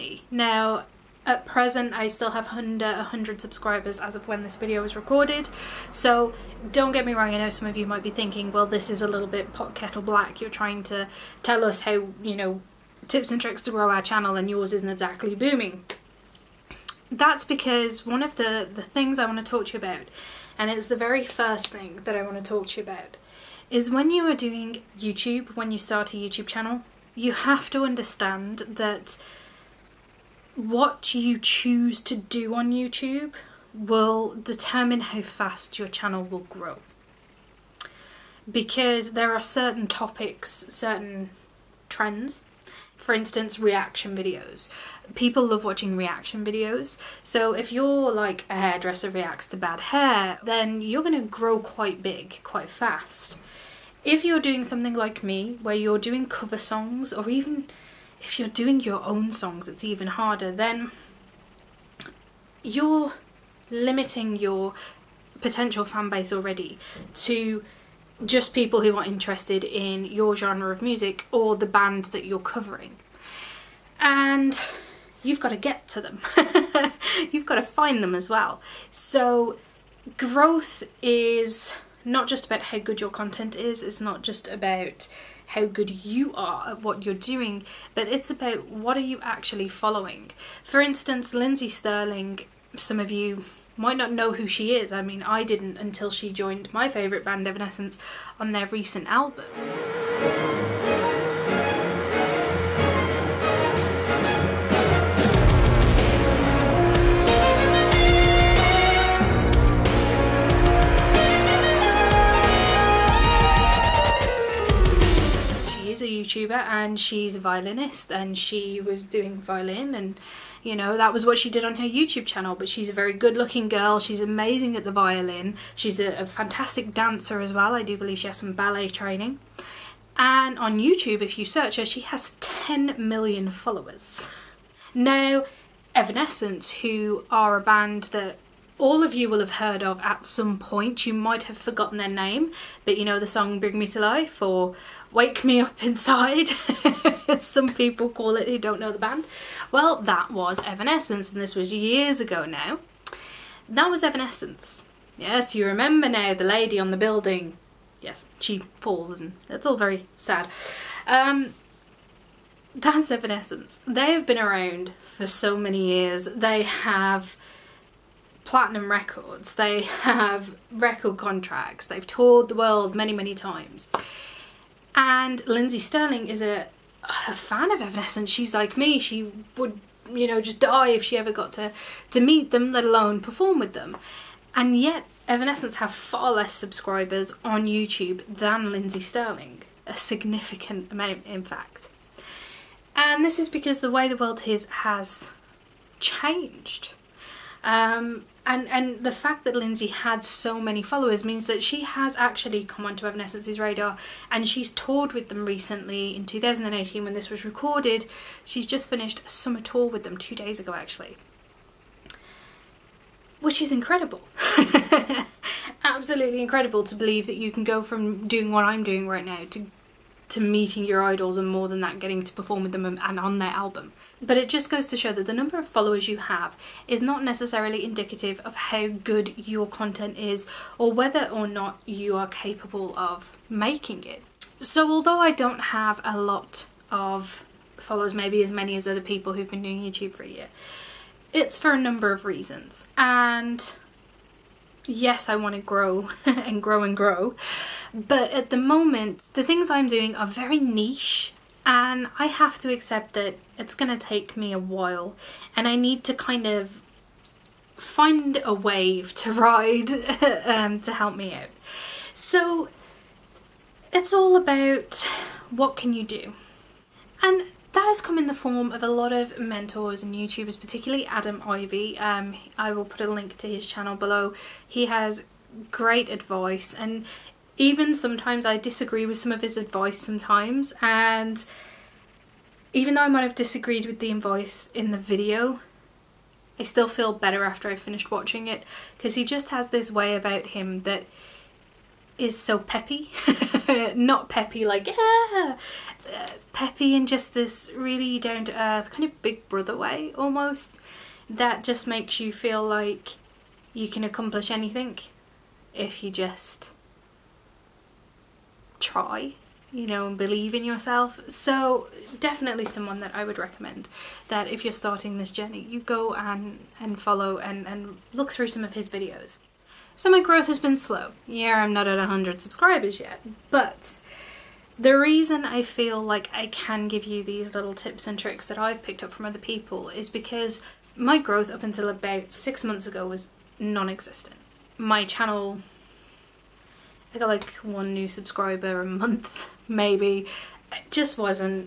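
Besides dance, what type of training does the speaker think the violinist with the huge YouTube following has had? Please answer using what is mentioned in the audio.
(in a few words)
Ballet.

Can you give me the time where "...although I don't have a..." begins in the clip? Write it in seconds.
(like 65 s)
234 s.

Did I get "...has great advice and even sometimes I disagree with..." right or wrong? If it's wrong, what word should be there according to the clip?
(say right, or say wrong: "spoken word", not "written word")
right.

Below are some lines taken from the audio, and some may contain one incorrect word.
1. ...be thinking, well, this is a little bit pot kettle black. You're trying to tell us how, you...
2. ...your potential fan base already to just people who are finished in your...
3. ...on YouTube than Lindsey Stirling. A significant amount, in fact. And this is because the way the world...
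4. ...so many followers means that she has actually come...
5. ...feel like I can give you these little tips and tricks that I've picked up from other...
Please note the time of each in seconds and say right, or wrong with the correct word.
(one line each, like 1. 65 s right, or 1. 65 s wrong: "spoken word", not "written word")
1. 8 s right
2. 64 s wrong: "interested", not "finished"
3. 187 s right
4. 200 s right
5. 325 s right.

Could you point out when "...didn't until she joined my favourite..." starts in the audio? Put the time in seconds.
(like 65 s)
95 s.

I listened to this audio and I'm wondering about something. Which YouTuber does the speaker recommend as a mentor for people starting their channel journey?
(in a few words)
Adam Ivy.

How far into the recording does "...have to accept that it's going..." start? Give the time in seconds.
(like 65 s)
252 s.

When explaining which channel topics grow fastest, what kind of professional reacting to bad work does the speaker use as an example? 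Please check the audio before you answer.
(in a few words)
Hairdresser.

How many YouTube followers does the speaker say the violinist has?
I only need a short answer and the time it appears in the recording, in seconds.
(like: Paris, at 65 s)
10 million, at 132 s.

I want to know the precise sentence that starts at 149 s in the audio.
Well, that was Evanescence, and this was years ago now.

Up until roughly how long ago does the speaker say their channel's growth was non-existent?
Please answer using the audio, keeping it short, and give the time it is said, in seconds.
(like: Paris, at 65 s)
6 months, at 332 s.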